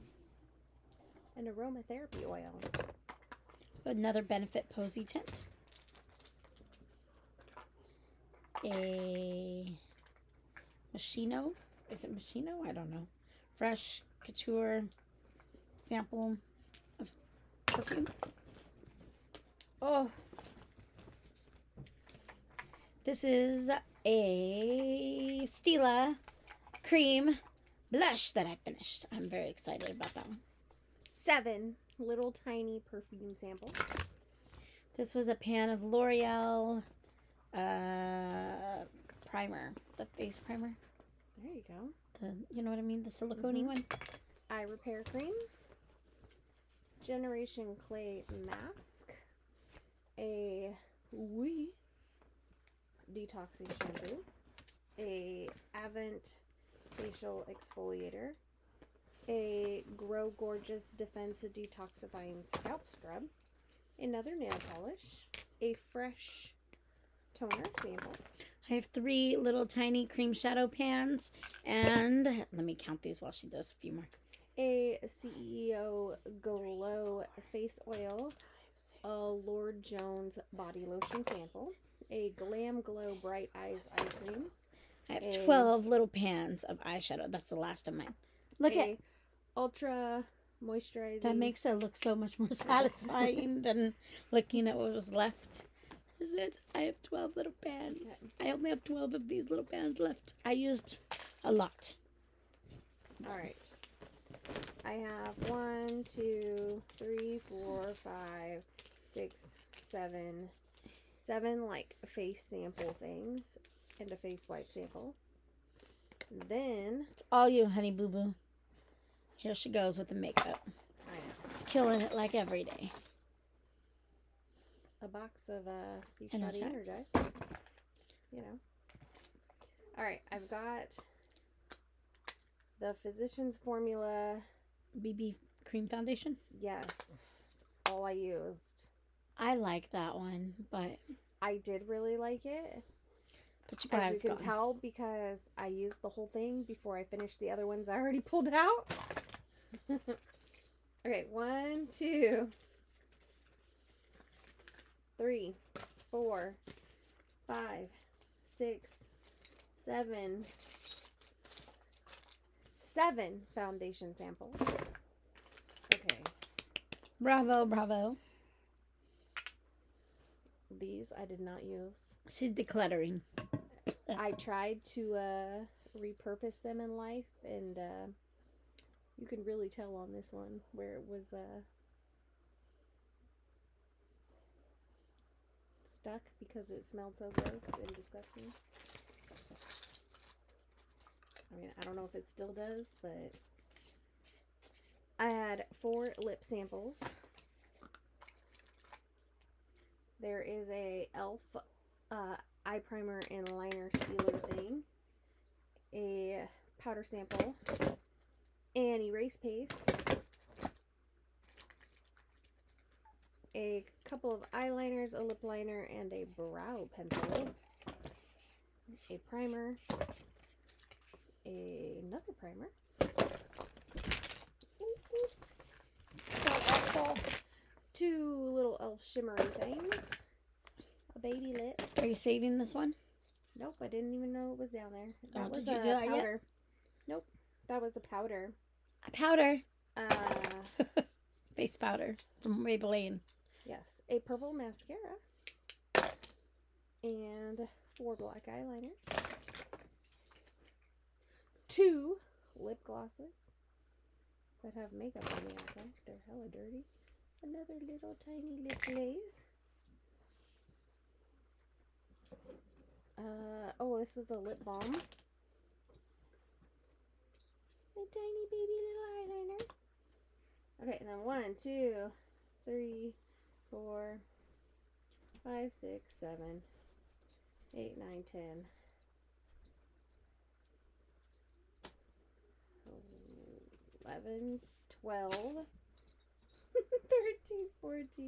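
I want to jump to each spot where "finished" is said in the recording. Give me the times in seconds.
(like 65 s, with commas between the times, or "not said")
28 s, 147 s.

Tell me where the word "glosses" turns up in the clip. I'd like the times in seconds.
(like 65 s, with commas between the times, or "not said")
252 s.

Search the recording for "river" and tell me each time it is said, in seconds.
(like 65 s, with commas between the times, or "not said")
not said.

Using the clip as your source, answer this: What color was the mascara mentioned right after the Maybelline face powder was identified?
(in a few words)
Purple.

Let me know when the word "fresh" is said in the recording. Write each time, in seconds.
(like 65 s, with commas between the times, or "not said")
13 s, 65 s.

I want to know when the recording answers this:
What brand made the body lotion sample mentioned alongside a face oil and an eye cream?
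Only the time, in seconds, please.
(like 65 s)
79 s.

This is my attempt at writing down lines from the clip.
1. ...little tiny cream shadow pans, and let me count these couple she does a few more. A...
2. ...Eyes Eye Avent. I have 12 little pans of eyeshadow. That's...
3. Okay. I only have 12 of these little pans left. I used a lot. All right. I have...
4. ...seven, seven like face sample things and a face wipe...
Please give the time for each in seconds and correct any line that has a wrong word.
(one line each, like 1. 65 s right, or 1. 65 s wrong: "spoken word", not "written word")
1. 69 s wrong: "while", not "couple"
2. 83 s wrong: "Cream", not "Avent"
3. 98 s right
4. 109 s right.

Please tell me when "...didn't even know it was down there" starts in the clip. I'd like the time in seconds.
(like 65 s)
233 s.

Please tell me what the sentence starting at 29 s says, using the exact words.
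I'm very excited about that one seven little tiny perfume samples.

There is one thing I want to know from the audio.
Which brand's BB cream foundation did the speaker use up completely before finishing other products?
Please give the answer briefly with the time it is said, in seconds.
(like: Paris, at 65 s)
Physicians Formula, at 133 s.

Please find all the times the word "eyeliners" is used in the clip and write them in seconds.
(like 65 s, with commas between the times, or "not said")
214 s, 248 s, 269 s.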